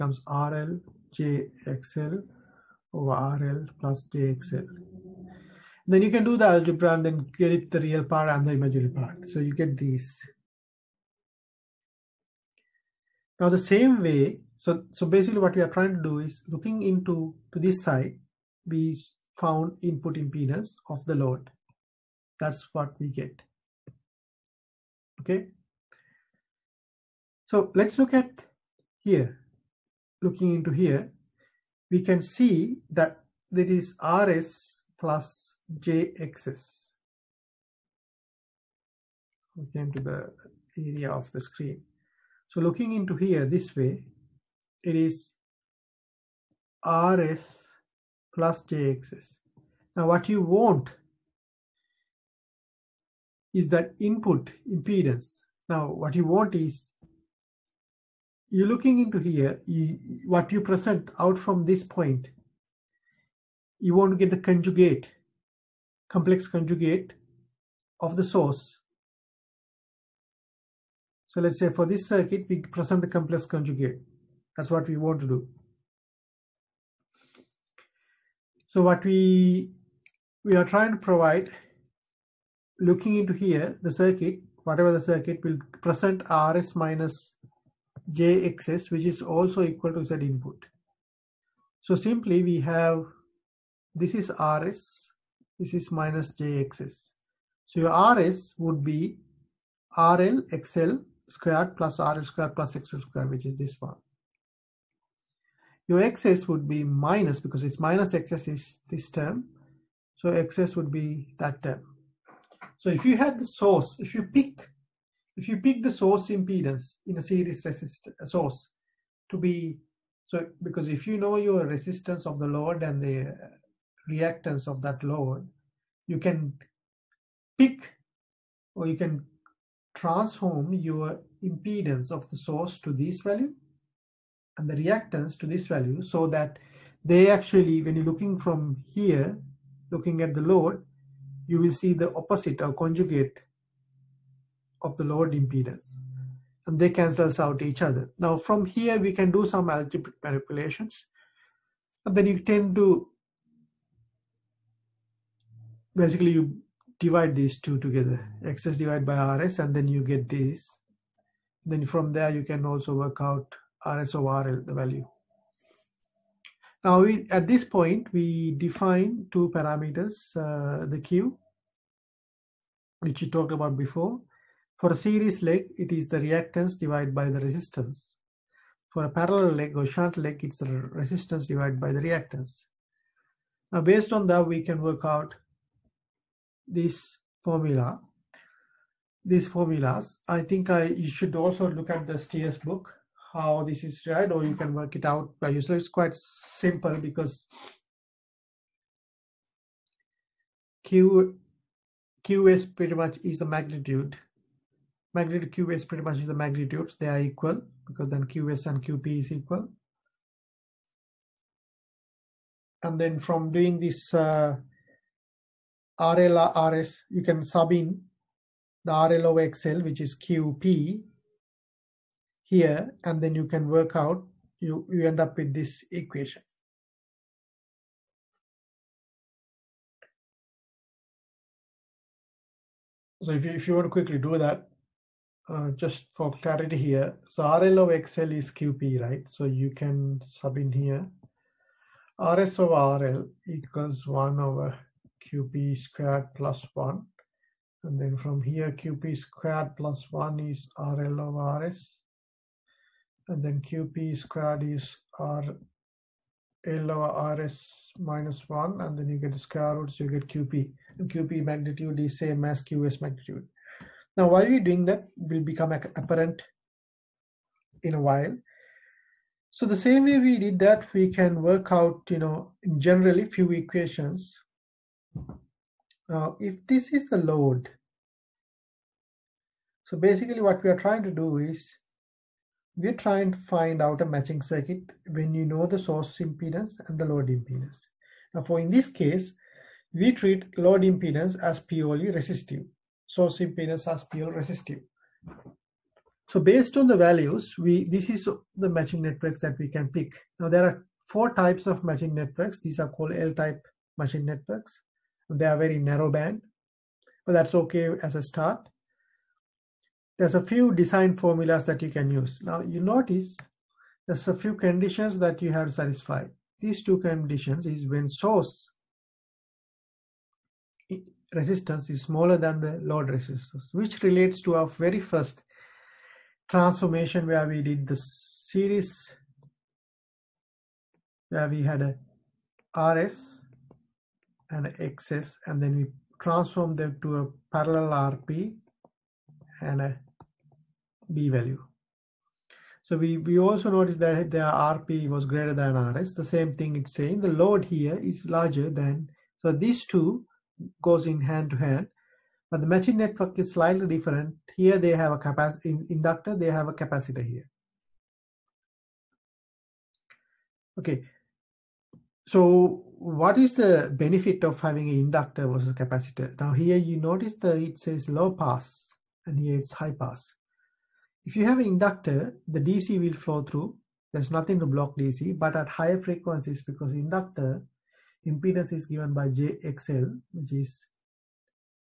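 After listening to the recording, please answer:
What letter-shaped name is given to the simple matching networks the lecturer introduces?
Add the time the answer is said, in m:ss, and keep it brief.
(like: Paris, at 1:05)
L-type, at 5:03.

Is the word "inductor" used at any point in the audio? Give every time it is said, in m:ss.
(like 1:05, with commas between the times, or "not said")
5:55, 6:04, 6:11, 6:16.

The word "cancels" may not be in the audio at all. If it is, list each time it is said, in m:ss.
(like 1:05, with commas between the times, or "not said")
2:26.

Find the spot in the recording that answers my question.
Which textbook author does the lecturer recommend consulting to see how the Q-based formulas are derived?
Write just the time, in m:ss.
3:12.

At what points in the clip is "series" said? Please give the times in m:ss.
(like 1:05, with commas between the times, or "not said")
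1:57, 2:54, 5:27.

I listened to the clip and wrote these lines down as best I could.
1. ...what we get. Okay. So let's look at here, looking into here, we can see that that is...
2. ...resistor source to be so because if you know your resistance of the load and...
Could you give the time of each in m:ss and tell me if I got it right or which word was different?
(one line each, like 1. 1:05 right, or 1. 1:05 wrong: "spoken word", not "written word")
1. 0:22 right
2. 1:57 right.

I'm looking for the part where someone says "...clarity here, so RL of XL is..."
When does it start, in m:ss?
3:56.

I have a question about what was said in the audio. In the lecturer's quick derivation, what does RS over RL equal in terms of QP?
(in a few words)
1 over QP squared plus 1.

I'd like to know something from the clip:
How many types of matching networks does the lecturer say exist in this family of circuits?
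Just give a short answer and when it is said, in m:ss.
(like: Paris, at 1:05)
4, at 5:01.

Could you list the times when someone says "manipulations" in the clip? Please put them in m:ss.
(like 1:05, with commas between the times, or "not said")
2:30.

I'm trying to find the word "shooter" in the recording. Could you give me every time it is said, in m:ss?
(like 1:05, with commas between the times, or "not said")
not said.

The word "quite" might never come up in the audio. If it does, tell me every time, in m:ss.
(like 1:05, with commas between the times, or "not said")
3:15.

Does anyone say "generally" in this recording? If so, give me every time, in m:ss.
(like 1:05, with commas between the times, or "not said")
4:32.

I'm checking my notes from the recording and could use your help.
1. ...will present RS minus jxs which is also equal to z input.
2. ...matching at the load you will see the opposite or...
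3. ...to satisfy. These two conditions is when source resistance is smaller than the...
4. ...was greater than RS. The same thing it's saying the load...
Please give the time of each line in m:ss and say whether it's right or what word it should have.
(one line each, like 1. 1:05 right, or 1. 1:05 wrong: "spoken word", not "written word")
1. 1:25 right
2. 2:19 wrong: "looking", not "matching"
3. 5:15 right
4. 5:45 right.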